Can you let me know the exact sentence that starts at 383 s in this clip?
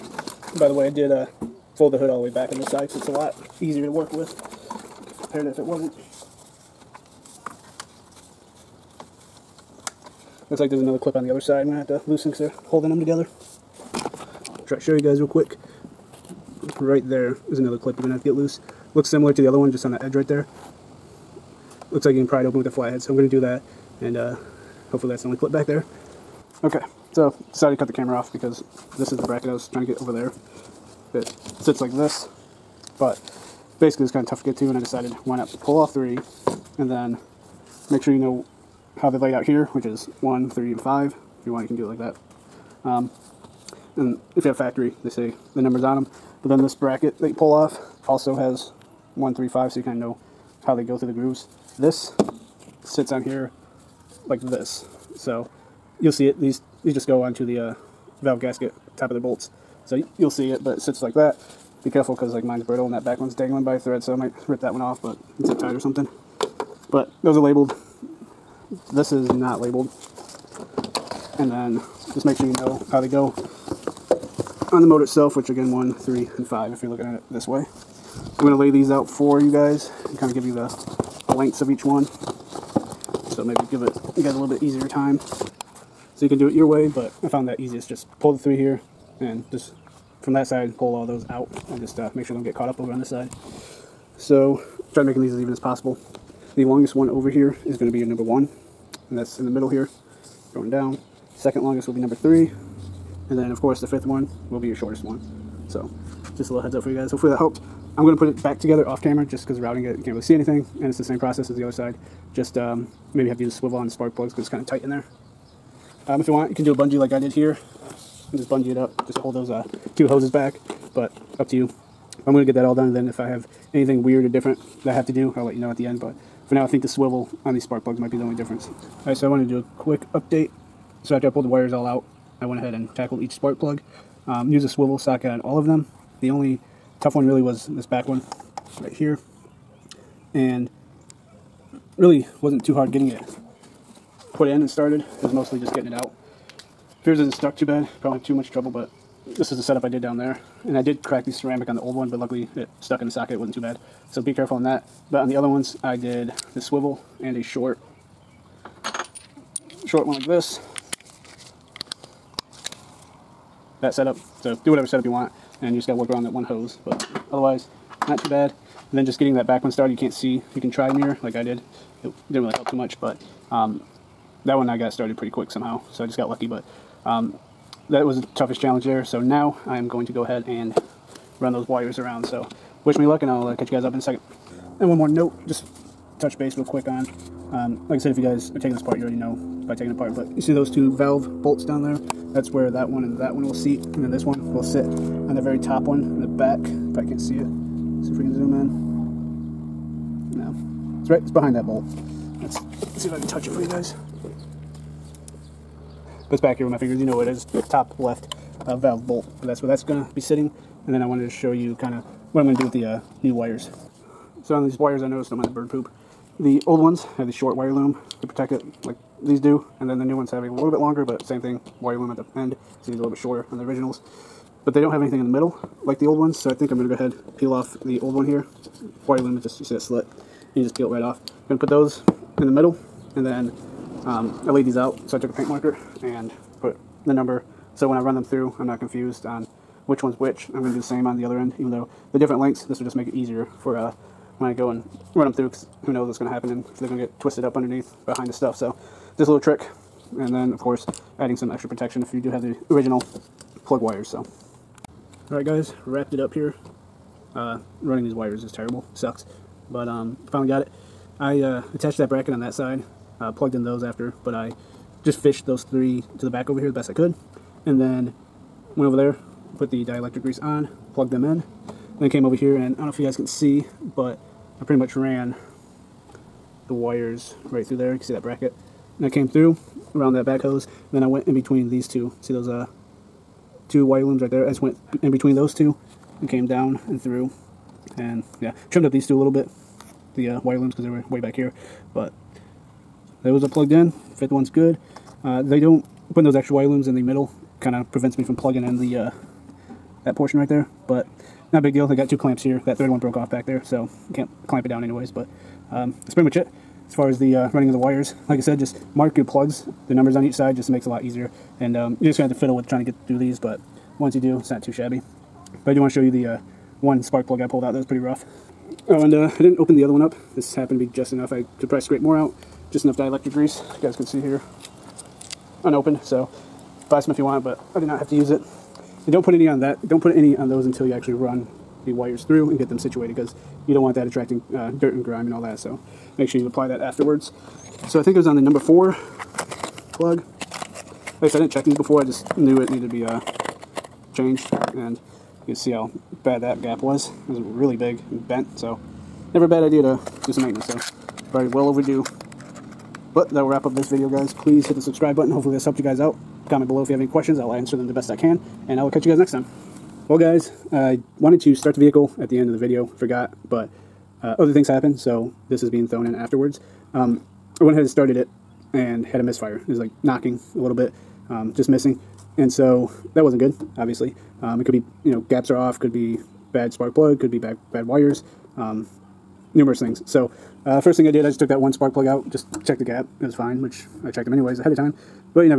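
It was fine, which I checked them anyways ahead of time.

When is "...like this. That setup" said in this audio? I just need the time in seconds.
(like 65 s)
160 s.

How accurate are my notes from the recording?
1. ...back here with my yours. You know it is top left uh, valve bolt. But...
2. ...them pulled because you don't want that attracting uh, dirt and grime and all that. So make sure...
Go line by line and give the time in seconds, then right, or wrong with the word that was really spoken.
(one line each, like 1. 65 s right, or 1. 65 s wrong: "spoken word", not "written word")
1. 206 s wrong: "fingers", not "yours"
2. 332 s wrong: "situated", not "pulled".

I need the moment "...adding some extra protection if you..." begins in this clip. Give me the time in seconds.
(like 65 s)
251 s.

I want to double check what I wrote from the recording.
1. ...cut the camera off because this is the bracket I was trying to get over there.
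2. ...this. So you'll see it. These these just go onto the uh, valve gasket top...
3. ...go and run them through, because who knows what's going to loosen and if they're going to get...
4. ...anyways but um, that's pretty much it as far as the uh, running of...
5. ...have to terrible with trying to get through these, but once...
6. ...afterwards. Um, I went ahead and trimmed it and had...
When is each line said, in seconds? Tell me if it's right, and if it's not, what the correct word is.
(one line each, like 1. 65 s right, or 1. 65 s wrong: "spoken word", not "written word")
1. 27 s right
2. 54 s right
3. 244 s wrong: "happen", not "loosen"
4. 304 s right
5. 312 s wrong: "fiddle", not "terrible"
6. 366 s wrong: "started", not "trimmed".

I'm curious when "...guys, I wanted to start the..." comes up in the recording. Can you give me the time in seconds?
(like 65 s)
360 s.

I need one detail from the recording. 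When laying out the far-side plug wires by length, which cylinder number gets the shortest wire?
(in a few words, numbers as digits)
5.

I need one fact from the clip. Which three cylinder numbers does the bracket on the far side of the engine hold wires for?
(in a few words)
1, 3, and 5.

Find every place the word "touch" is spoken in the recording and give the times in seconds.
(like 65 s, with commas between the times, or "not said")
186 s, 203 s.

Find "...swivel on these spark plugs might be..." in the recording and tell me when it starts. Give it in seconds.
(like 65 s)
126 s.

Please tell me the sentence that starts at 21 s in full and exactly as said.
Looks like you can pry it open with the flathead, so I'm going to do that.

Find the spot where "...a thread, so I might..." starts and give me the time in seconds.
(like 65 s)
63 s.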